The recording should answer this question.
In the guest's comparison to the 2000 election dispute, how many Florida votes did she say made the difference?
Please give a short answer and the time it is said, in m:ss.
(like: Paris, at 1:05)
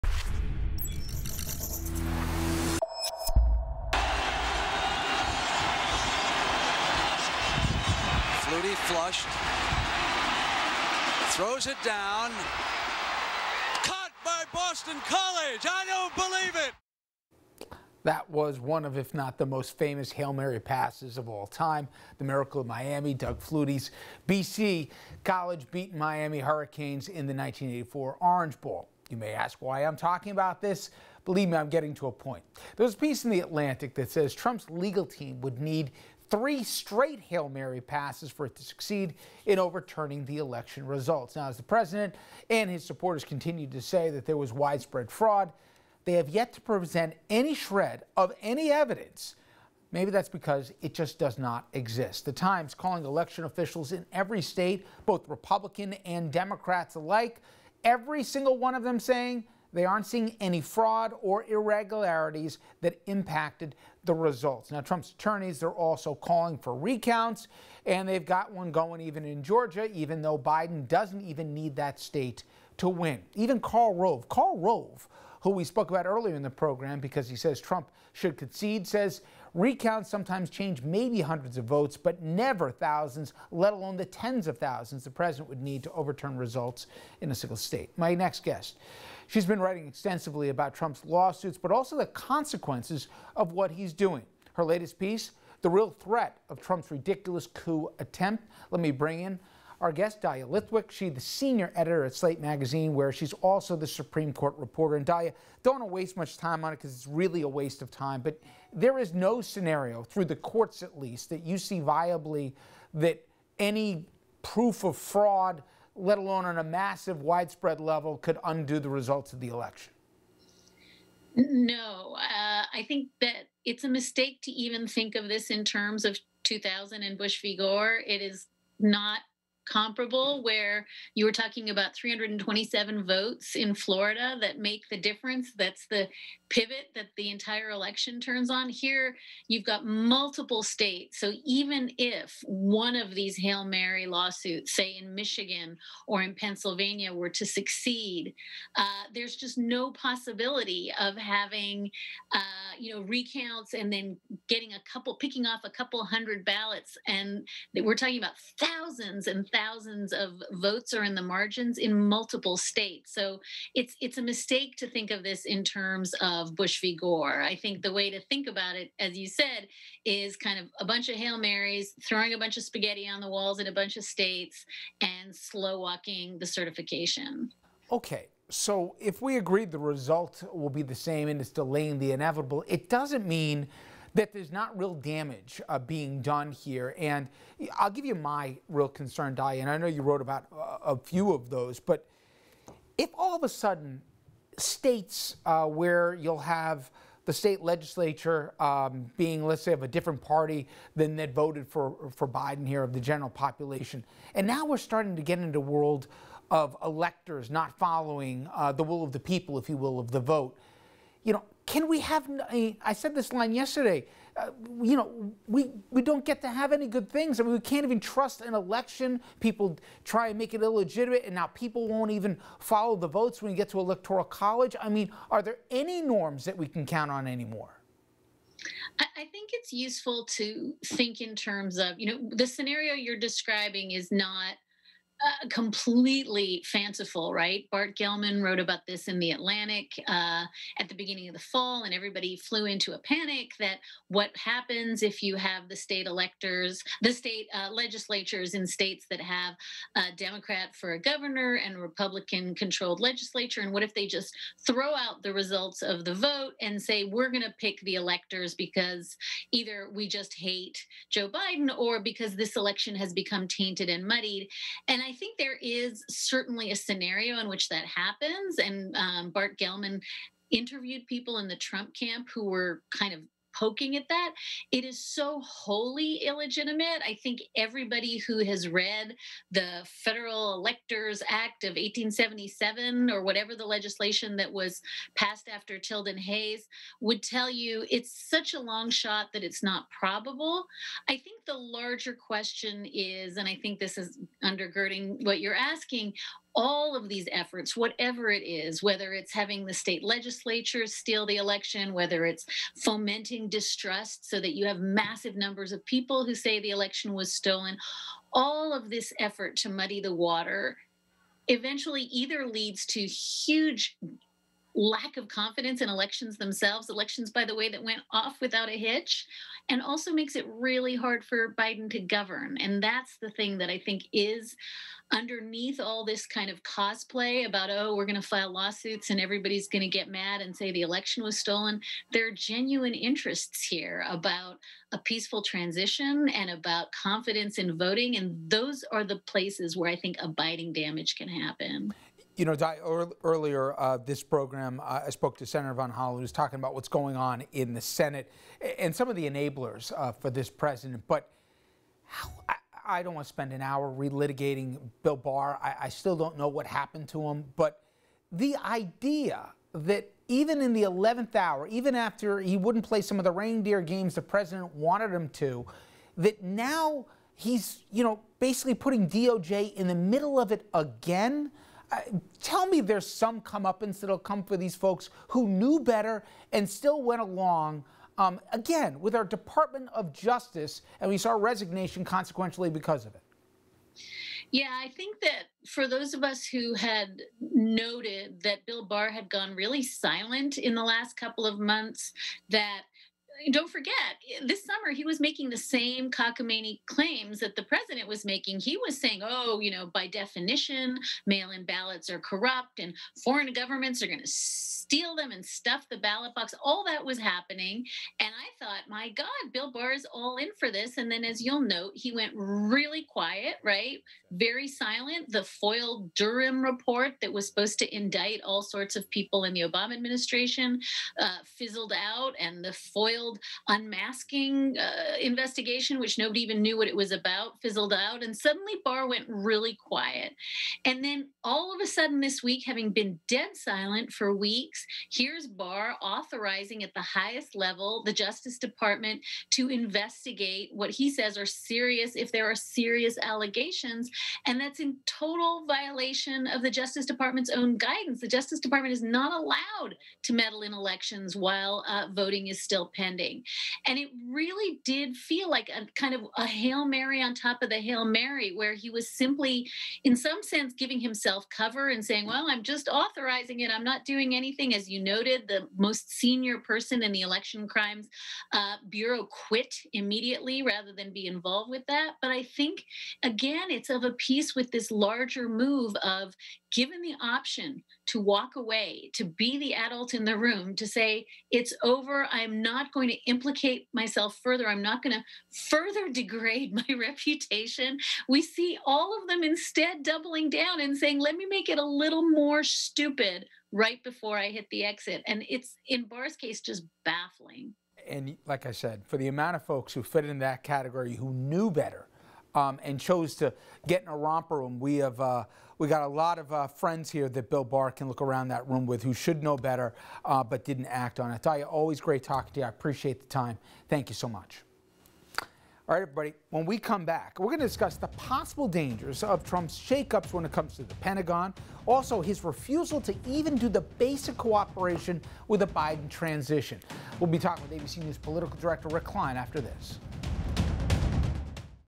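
327, at 2:11.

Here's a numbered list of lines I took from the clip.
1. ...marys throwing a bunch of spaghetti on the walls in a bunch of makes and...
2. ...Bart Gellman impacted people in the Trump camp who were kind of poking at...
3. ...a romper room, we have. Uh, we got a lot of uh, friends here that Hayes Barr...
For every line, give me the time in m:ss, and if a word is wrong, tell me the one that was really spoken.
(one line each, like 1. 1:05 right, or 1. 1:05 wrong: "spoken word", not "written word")
1. 2:51 wrong: "states", not "makes"
2. 4:29 wrong: "interviewed", not "impacted"
3. 8:24 wrong: "Bill", not "Hayes".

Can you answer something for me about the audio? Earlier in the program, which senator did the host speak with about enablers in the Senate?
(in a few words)
Senator Von Hollen.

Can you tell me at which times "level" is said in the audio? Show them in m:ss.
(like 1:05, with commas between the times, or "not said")
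1:57, 7:17.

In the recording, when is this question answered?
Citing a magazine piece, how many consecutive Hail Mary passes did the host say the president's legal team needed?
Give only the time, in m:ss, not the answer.
0:36.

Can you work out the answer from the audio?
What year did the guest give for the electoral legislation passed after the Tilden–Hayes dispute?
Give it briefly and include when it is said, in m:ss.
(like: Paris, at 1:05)
1877, at 4:41.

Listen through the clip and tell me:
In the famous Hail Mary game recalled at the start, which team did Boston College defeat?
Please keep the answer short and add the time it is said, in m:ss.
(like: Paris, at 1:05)
Miami Hurricanes, at 0:25.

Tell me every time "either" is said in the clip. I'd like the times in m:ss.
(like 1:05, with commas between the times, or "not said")
4:19, 5:12.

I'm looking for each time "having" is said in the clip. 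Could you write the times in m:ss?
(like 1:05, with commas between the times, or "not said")
2:31, 4:59, 7:12.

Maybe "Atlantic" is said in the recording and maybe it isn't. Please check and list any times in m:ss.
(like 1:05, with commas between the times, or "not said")
0:33, 3:59.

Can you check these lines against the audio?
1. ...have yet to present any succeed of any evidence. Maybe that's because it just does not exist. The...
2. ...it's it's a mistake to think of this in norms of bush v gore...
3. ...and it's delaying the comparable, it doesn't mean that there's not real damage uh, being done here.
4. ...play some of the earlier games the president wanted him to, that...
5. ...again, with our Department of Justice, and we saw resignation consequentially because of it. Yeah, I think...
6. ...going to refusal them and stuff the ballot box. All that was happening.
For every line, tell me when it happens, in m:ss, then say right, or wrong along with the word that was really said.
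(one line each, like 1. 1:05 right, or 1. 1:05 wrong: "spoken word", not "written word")
1. 0:46 wrong: "shred", not "succeed"
2. 2:43 wrong: "terms", not "norms"
3. 3:01 wrong: "inevitable", not "comparable"
4. 6:02 wrong: "reindeer", not "earlier"
5. 6:18 right
6. 6:44 wrong: "steal", not "refusal".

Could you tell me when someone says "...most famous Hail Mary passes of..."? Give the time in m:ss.
0:19.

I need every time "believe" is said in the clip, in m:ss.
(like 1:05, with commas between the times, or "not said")
0:16, 0:31.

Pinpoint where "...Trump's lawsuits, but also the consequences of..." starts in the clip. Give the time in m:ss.
1:30.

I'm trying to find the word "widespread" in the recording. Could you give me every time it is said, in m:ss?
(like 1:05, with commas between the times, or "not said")
0:44, 1:57.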